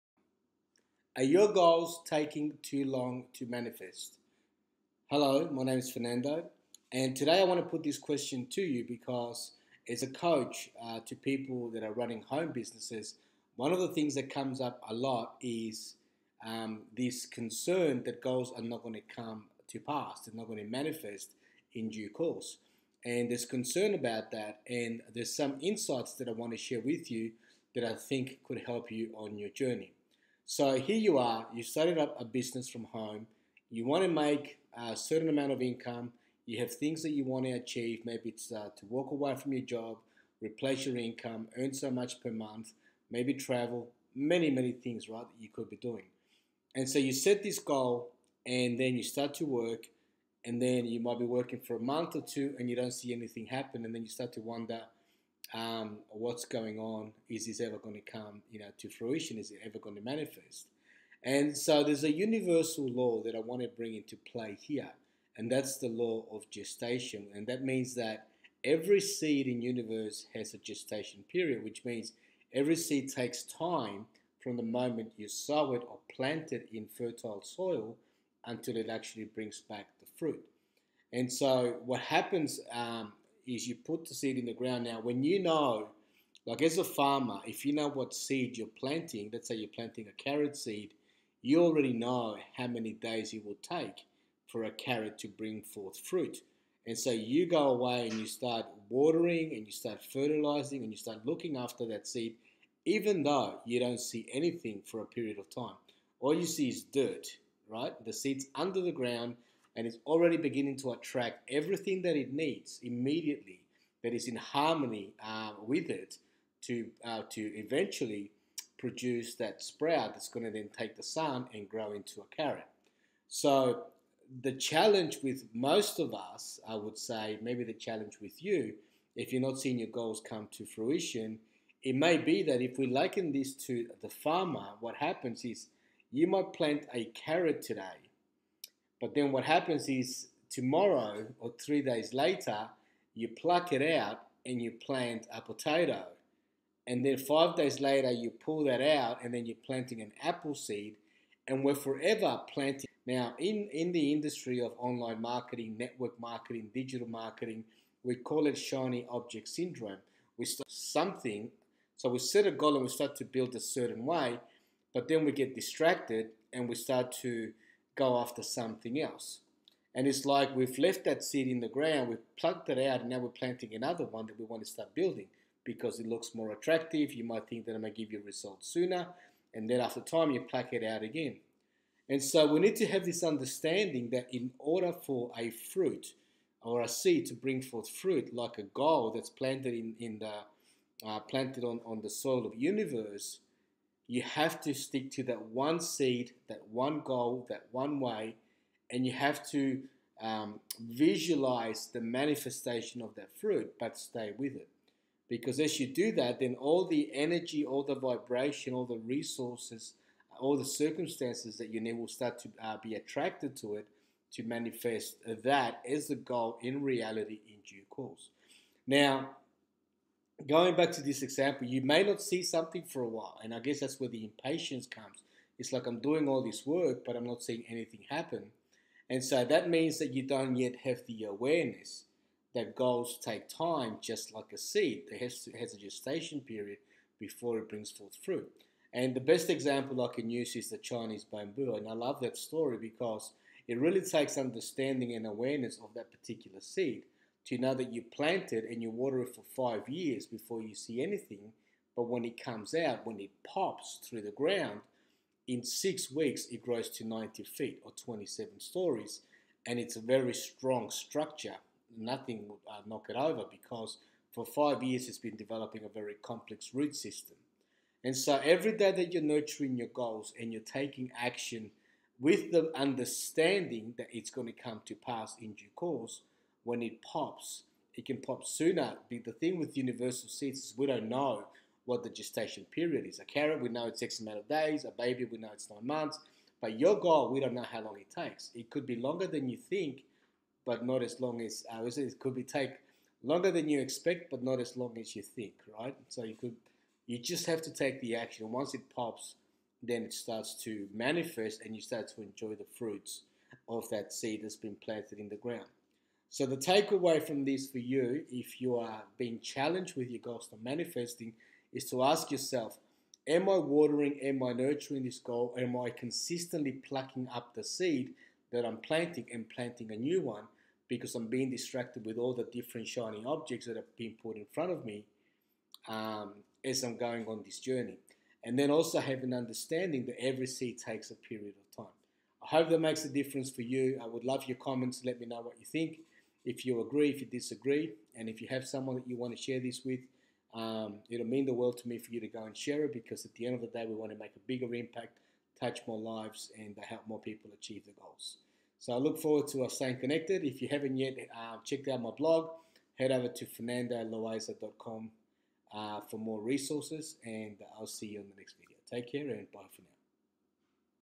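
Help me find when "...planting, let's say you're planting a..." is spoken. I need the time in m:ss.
1:28.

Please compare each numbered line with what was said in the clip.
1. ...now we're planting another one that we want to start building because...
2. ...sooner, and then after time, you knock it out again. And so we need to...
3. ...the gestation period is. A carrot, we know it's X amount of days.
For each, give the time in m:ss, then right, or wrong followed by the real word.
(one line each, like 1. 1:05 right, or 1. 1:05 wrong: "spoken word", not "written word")
1. 2:53 right
2. 2:58 wrong: "pluck", not "knock"
3. 4:42 right.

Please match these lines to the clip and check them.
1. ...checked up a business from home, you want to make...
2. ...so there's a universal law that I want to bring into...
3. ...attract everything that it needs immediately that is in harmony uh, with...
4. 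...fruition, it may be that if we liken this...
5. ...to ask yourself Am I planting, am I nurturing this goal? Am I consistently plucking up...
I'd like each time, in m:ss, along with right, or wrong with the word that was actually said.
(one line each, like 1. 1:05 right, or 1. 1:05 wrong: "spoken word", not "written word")
1. 0:31 wrong: "started", not "checked"
2. 1:01 right
3. 1:50 right
4. 2:10 right
5. 5:11 wrong: "watering", not "planting".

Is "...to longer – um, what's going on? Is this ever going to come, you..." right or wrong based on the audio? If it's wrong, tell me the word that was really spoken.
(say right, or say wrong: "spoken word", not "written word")
wrong: "wonder", not "longer".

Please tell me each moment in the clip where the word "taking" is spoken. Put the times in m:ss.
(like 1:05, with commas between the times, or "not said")
0:02, 4:30.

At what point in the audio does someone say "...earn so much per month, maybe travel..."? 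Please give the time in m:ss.
0:41.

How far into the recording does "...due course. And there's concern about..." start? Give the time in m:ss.
0:21.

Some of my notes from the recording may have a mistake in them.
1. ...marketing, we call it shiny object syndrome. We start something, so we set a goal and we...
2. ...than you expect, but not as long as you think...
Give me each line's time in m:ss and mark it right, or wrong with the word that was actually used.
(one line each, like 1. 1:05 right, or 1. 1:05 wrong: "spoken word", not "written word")
1. 2:37 right
2. 4:53 right.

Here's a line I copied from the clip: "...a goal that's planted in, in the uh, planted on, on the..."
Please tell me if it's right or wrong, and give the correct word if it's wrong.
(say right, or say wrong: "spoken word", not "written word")
right.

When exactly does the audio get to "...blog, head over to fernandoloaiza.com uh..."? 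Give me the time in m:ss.
5:52.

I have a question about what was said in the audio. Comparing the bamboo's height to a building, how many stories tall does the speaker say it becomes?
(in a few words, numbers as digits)
27 stories.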